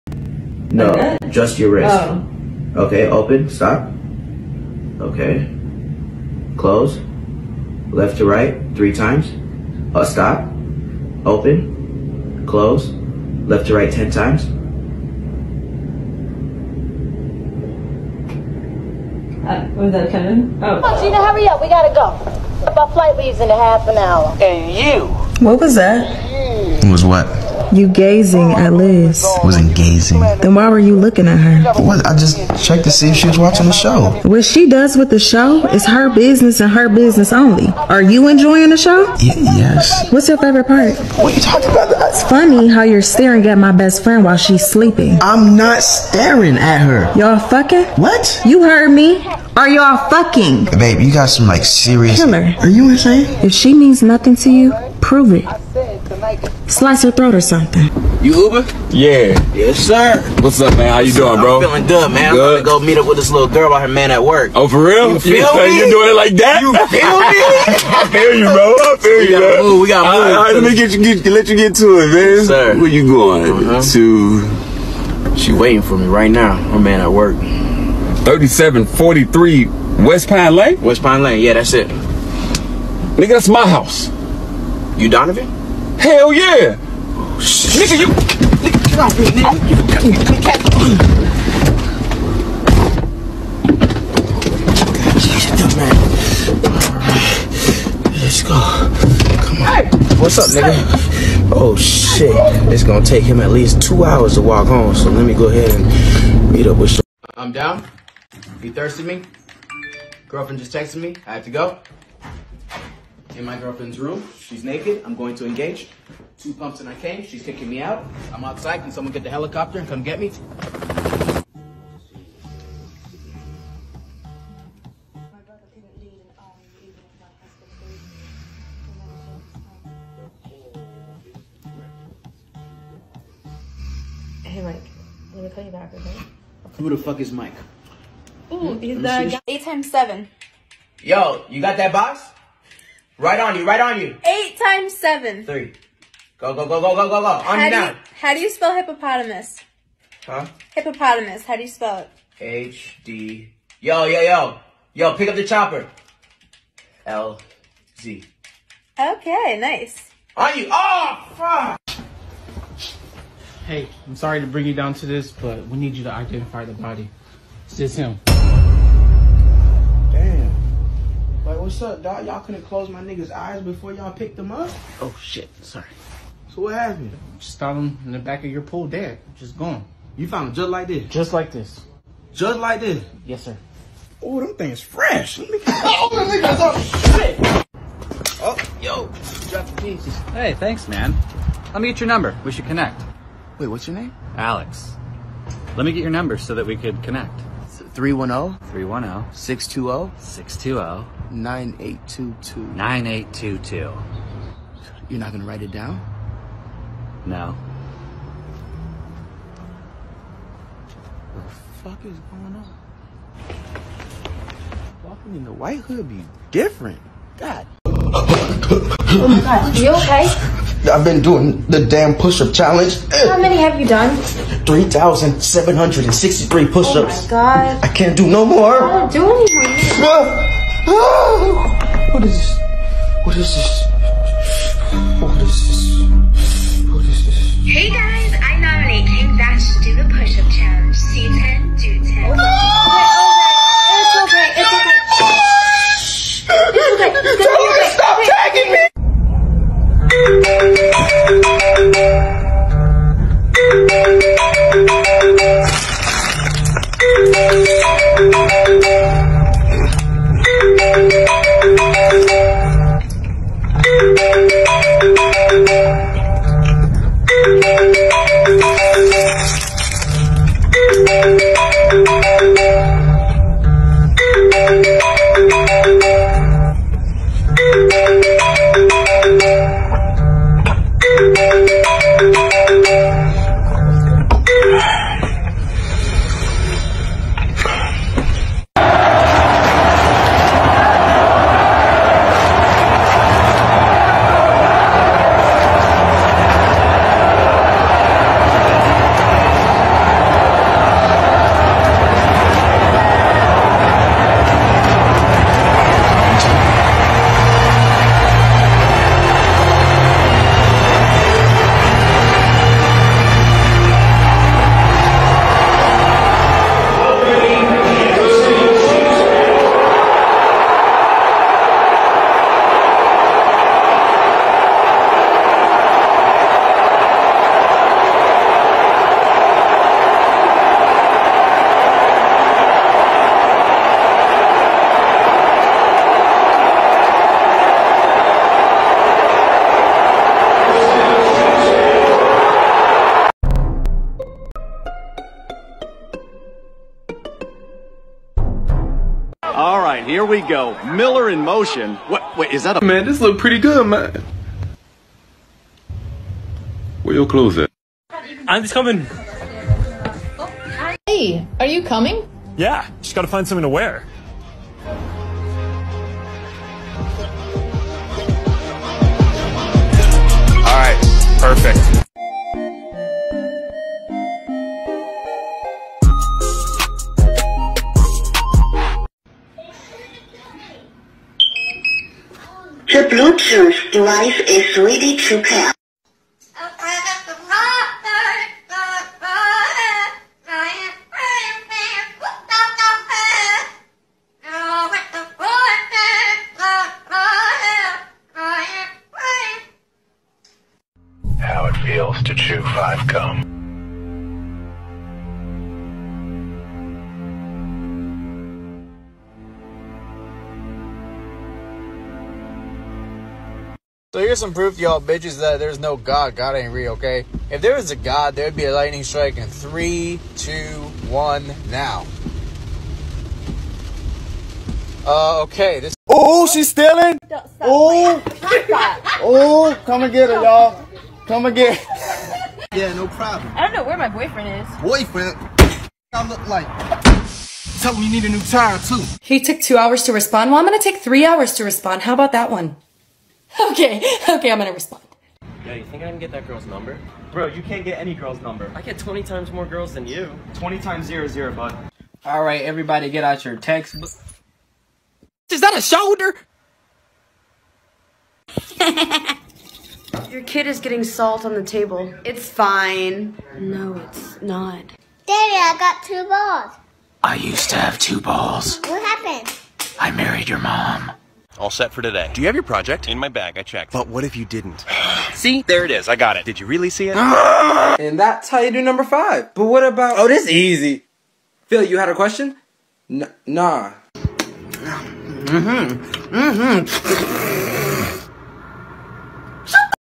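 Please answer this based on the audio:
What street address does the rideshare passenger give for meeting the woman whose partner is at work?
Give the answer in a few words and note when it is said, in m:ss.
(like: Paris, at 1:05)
3743 West Pine Lane, at 1:18.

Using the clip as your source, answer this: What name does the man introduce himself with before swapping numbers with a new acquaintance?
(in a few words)
Alex.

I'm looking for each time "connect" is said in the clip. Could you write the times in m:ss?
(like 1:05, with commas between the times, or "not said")
3:12, 3:17.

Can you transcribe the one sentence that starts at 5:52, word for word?
Man, this look pretty good, man.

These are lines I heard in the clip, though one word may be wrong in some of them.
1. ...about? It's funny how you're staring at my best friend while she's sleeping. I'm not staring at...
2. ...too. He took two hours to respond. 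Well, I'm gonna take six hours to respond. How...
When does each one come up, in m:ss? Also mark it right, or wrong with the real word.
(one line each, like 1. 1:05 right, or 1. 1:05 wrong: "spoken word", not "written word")
1. 0:41 right
2. 7:18 wrong: "three", not "six".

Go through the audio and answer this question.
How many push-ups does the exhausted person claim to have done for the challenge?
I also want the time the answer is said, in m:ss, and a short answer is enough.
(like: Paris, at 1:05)
3,763, at 3:44.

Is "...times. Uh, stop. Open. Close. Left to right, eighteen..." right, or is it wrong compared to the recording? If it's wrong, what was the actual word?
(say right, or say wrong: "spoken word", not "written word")
wrong: "ten", not "eighteen".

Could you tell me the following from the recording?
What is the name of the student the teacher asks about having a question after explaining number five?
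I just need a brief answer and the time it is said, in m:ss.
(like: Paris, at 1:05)
Phil, at 8:01.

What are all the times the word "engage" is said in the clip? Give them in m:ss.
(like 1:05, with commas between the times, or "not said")
1:55.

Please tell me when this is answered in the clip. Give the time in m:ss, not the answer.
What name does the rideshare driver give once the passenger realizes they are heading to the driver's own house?
1:25.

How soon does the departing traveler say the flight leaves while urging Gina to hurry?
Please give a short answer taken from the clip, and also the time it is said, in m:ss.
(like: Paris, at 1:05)
half an hour, at 0:23.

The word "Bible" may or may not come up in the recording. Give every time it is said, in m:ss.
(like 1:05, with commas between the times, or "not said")
not said.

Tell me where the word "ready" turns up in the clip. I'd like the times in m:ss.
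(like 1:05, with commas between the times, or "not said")
6:24.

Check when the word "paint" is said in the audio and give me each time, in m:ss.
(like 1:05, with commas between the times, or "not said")
not said.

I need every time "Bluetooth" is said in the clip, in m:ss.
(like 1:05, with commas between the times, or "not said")
6:23.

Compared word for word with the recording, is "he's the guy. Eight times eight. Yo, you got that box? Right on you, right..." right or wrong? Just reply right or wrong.
wrong.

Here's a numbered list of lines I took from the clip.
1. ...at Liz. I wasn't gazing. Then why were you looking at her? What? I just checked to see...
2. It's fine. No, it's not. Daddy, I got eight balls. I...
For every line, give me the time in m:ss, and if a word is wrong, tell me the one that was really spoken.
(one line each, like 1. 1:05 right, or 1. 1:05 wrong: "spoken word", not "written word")
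1. 0:28 right
2. 7:42 wrong: "two", not "eight".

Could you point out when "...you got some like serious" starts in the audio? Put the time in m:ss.
0:50.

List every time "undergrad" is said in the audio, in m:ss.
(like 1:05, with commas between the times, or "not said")
not said.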